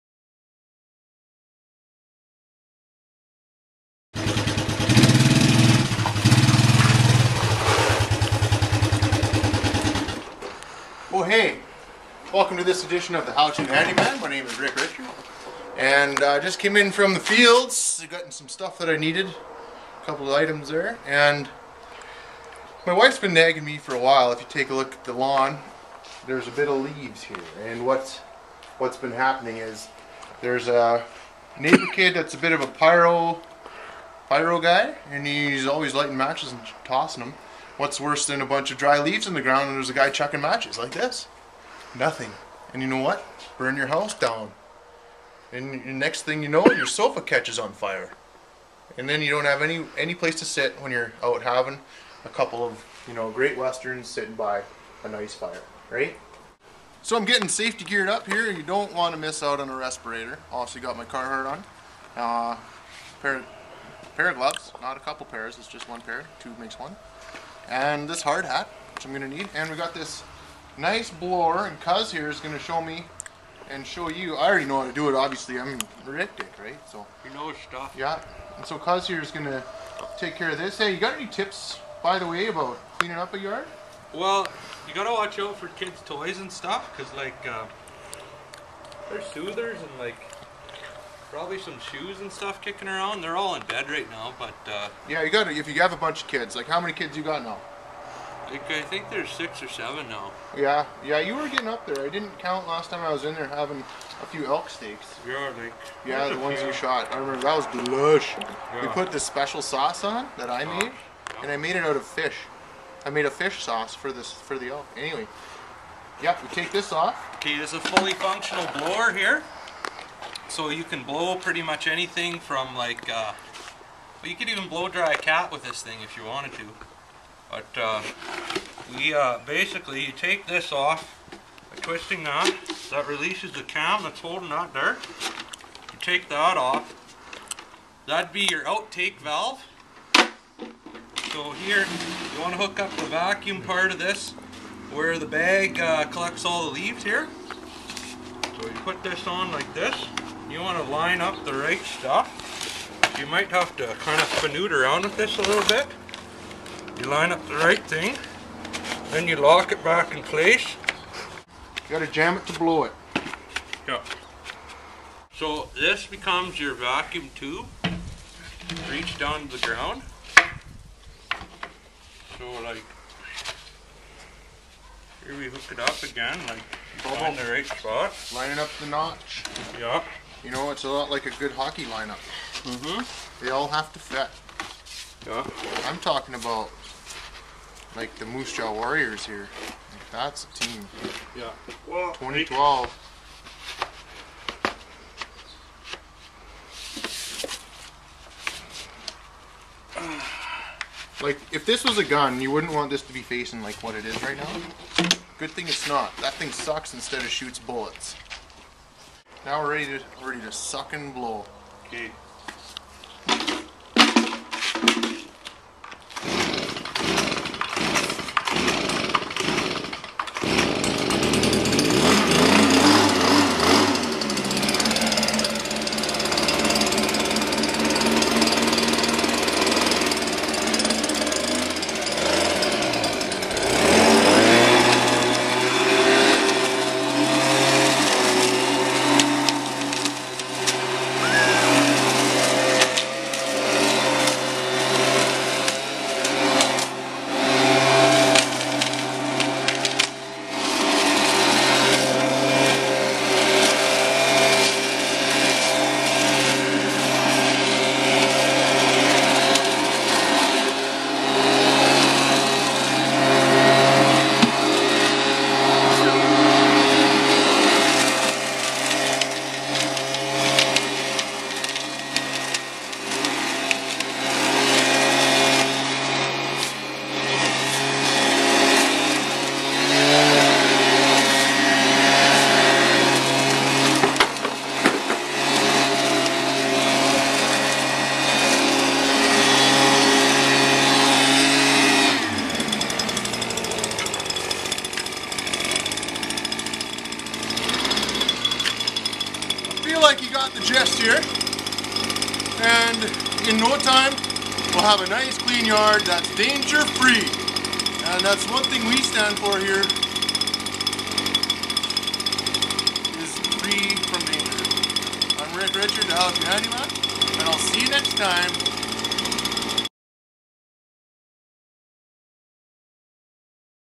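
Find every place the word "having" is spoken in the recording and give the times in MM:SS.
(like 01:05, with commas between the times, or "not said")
00:51, 01:43.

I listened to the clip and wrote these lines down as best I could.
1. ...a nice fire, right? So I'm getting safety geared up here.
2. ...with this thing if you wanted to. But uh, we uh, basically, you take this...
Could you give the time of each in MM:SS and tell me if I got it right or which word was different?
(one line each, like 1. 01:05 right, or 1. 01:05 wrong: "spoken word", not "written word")
1. 00:55 right
2. 02:05 right.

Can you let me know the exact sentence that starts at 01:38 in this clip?
I think there's six or seven now.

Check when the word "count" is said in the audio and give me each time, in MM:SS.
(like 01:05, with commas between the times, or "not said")
01:42.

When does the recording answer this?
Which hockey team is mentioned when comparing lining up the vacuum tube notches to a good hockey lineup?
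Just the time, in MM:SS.
03:08.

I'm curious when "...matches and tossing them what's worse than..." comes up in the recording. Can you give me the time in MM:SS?
00:36.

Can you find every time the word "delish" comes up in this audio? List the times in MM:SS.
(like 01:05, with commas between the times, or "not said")
01:47.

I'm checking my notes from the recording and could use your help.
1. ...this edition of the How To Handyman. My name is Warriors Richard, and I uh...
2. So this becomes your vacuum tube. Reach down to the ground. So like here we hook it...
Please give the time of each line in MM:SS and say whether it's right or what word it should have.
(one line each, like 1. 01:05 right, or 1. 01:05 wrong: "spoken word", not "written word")
1. 00:12 wrong: "Rick", not "Warriors"
2. 02:45 right.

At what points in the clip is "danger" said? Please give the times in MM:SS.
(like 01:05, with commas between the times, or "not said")
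05:06, 05:14.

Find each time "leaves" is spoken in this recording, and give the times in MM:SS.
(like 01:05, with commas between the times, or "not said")
00:26, 00:39, 02:26.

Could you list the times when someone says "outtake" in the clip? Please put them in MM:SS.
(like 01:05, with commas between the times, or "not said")
02:18.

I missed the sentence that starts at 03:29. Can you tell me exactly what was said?
Now we're ready to ready to suck and blow.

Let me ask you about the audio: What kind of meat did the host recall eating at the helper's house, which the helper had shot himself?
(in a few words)
elk steaks.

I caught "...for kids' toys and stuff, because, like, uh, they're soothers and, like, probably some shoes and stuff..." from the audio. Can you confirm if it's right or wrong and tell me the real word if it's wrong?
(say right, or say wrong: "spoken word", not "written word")
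right.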